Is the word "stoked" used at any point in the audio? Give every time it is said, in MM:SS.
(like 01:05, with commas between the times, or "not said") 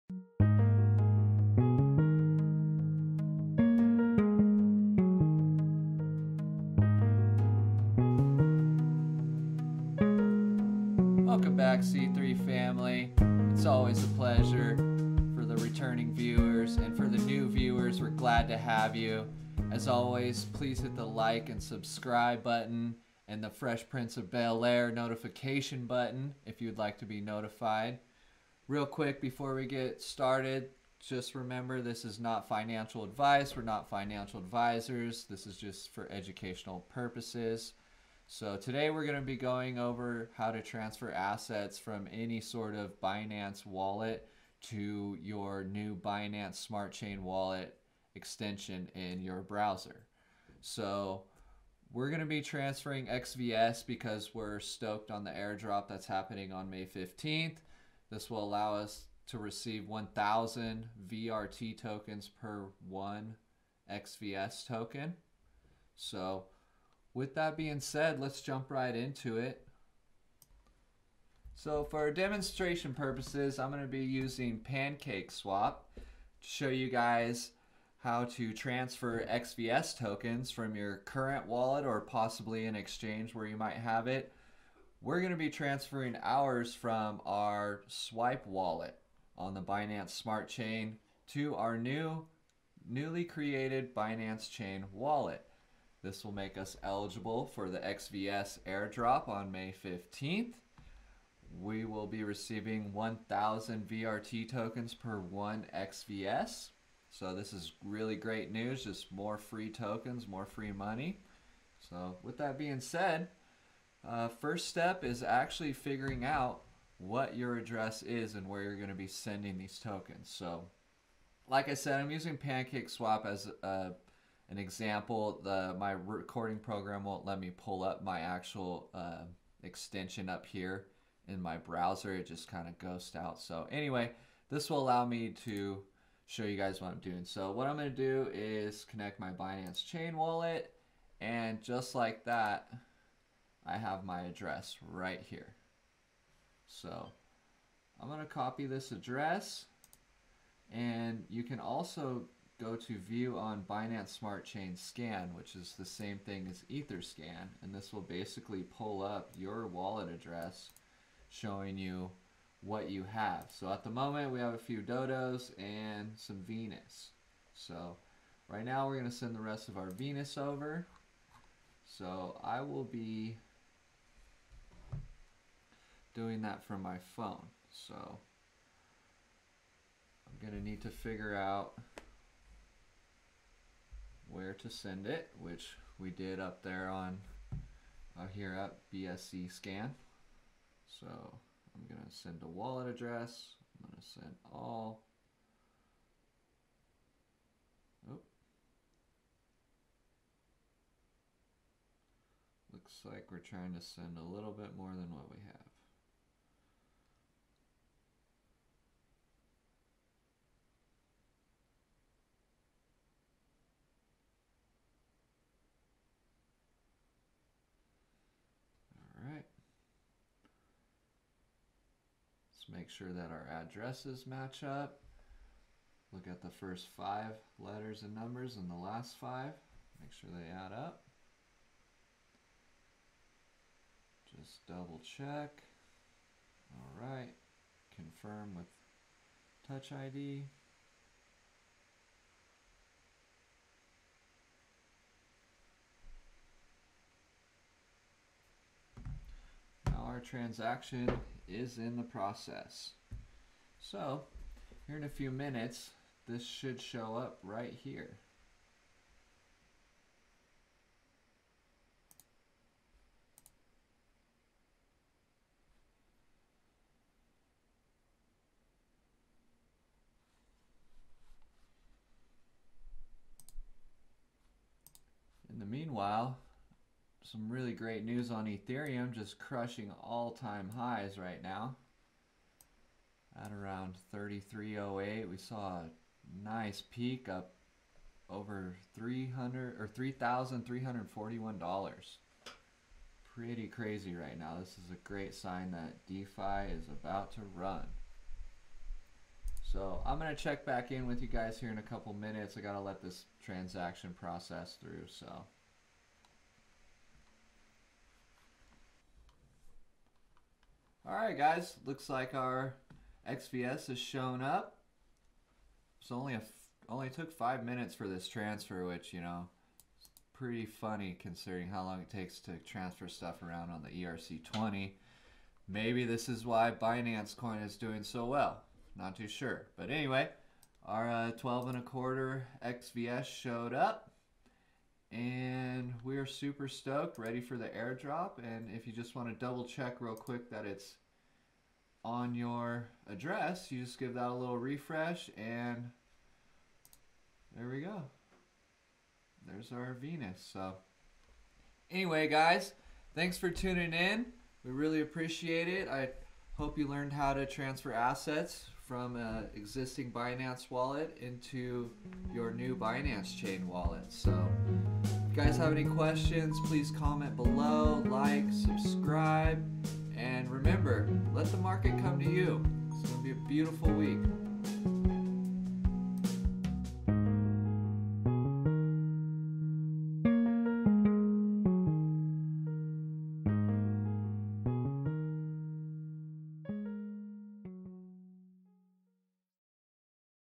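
00:54, 05:36.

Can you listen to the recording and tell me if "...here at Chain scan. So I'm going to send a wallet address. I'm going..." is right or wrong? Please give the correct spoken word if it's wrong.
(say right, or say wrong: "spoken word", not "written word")
wrong: "BSC", not "Chain".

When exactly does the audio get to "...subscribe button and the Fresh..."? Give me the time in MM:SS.
00:21.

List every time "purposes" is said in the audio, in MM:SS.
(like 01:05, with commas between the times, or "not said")
00:36, 01:12.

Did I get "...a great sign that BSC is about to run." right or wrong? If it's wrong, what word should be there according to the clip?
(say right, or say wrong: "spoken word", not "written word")
wrong: "DeFi", not "BSC".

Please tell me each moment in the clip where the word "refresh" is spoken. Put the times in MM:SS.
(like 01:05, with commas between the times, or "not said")
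05:44.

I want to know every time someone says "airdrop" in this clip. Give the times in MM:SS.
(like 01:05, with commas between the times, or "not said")
00:55, 01:38, 05:37.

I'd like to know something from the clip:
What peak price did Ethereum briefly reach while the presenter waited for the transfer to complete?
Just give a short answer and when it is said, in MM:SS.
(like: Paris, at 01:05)
$3,341, at 04:49.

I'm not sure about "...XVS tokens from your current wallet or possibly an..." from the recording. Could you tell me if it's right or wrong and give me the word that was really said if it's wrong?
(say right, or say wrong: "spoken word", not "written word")
right.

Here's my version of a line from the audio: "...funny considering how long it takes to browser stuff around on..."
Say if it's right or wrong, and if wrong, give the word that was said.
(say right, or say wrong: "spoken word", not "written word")
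wrong: "transfer", not "browser".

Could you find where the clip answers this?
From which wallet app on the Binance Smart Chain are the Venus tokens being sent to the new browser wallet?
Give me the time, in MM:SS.
01:27.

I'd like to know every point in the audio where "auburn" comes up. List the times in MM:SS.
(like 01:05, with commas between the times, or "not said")
not said.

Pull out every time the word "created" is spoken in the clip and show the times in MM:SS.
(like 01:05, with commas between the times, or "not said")
01:33.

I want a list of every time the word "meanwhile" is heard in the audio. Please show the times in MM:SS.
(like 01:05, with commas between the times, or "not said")
04:35.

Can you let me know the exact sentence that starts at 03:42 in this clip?
make sure that our addresses match up.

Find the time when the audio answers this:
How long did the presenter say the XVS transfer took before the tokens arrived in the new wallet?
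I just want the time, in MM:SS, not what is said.
05:17.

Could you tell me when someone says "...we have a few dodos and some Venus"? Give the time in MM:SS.
02:44.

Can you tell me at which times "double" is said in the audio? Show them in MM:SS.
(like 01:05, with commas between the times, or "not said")
03:54, 05:39.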